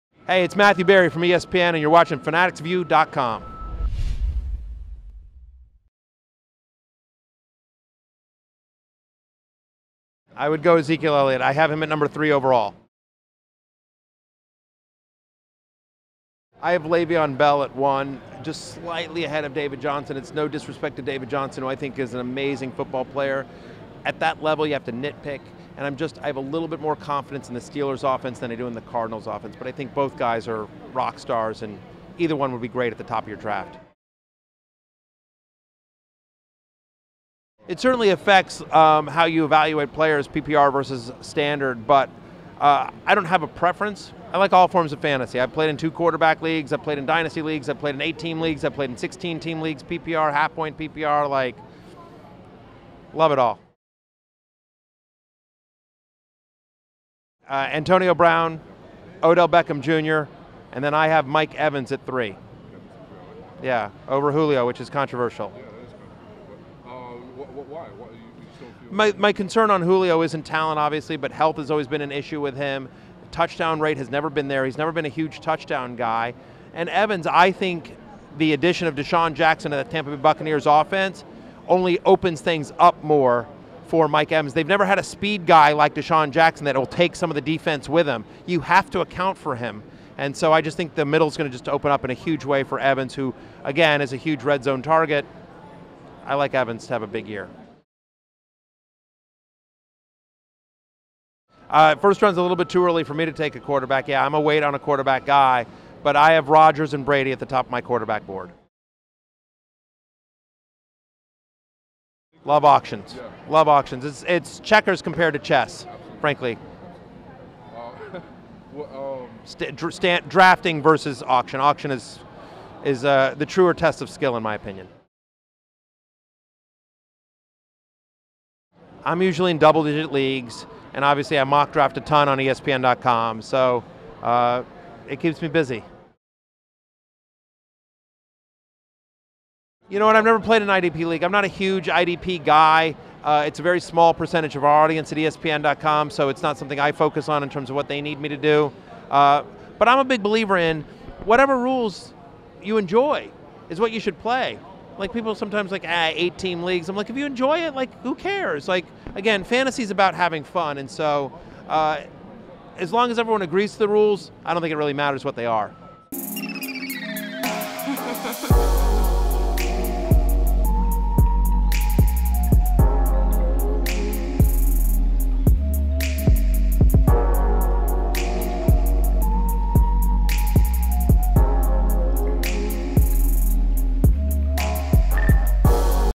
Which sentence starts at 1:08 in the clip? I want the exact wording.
my, my concern on Julio isn't talent, obviously, but health has always been an issue with him.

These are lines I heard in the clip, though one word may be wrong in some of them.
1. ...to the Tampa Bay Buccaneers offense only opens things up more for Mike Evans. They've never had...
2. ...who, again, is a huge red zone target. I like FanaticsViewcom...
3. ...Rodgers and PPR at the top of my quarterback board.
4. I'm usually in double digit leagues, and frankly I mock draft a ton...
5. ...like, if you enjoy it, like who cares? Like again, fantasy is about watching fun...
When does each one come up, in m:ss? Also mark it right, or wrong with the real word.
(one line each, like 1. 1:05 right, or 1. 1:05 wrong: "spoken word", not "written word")
1. 1:19 right
2. 1:33 wrong: "Evans", not "FanaticsViewcom"
3. 1:46 wrong: "Brady", not "PPR"
4. 2:09 wrong: "obviously", not "frankly"
5. 2:36 wrong: "having", not "watching".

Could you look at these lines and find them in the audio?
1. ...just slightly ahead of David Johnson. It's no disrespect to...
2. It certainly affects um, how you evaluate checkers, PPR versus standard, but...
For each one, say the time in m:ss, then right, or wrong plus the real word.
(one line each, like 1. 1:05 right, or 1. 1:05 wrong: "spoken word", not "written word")
1. 0:18 right
2. 0:37 wrong: "players", not "checkers".